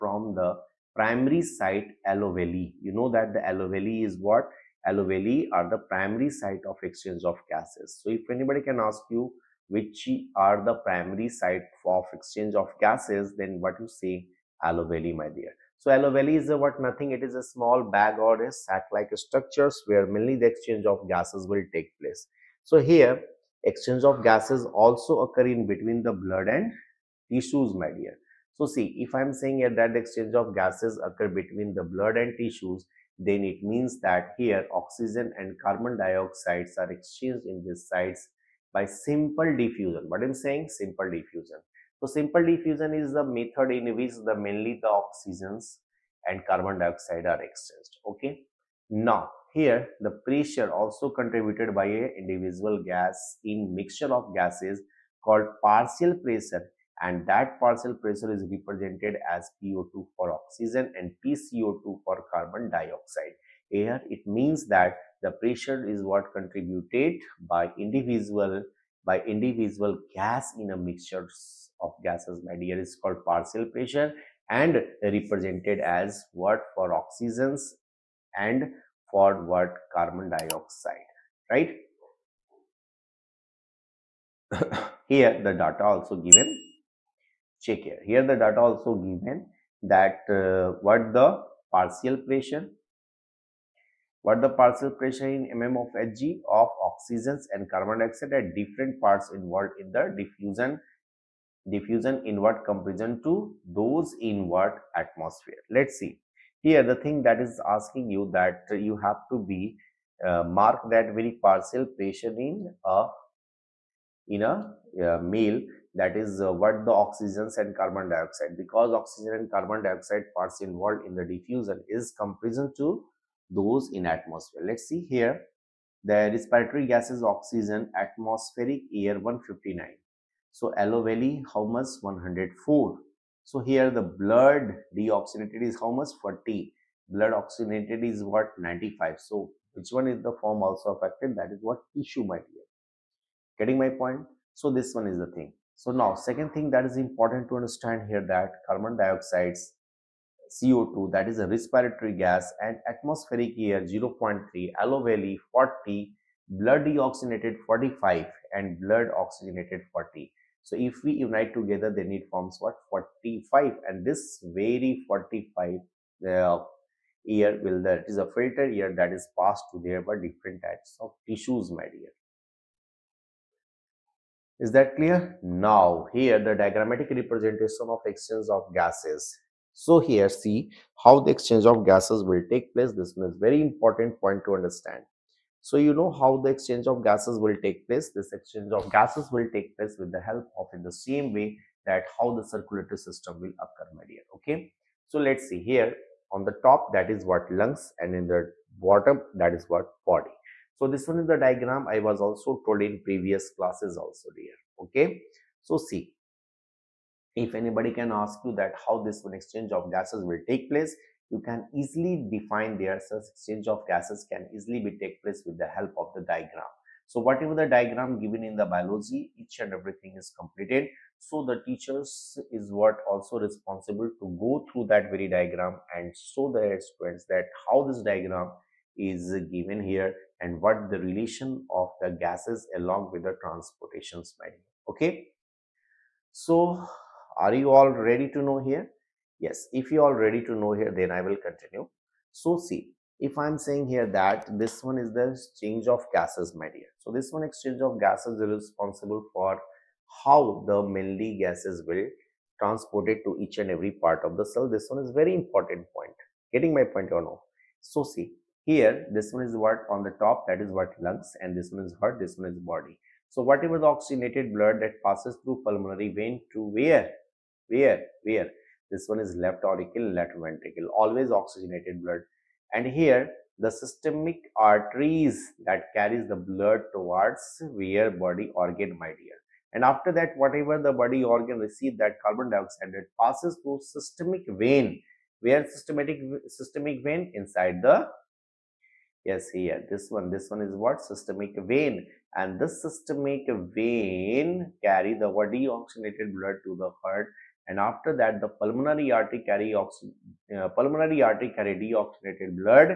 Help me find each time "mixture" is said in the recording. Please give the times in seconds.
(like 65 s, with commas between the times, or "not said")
53 s, 70 s.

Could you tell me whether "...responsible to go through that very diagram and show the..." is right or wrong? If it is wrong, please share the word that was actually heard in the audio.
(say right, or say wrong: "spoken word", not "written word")
right.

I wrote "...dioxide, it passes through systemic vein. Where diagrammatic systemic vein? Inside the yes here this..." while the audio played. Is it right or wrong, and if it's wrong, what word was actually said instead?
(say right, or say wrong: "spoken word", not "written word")
wrong: "systematic", not "diagrammatic".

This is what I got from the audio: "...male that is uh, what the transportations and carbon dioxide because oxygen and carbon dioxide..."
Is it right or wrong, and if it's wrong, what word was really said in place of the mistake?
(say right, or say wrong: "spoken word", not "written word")
wrong: "oxygens", not "transportations".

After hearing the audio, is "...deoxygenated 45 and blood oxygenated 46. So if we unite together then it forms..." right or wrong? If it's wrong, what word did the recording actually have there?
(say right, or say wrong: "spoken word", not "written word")
wrong: "40", not "46".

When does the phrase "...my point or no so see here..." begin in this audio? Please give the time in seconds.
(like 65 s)
256 s.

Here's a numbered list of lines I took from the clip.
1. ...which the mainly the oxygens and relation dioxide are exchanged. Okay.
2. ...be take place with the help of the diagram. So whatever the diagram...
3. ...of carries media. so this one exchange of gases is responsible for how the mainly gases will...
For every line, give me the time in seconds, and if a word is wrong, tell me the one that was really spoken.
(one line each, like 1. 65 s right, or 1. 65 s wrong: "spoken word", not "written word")
1. 43 s wrong: "carbon", not "relation"
2. 214 s right
3. 245 s wrong: "gases", not "carries".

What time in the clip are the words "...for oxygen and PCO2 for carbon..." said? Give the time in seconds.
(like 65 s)
60 s.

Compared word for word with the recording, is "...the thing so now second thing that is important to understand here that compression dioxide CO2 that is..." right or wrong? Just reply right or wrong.
wrong.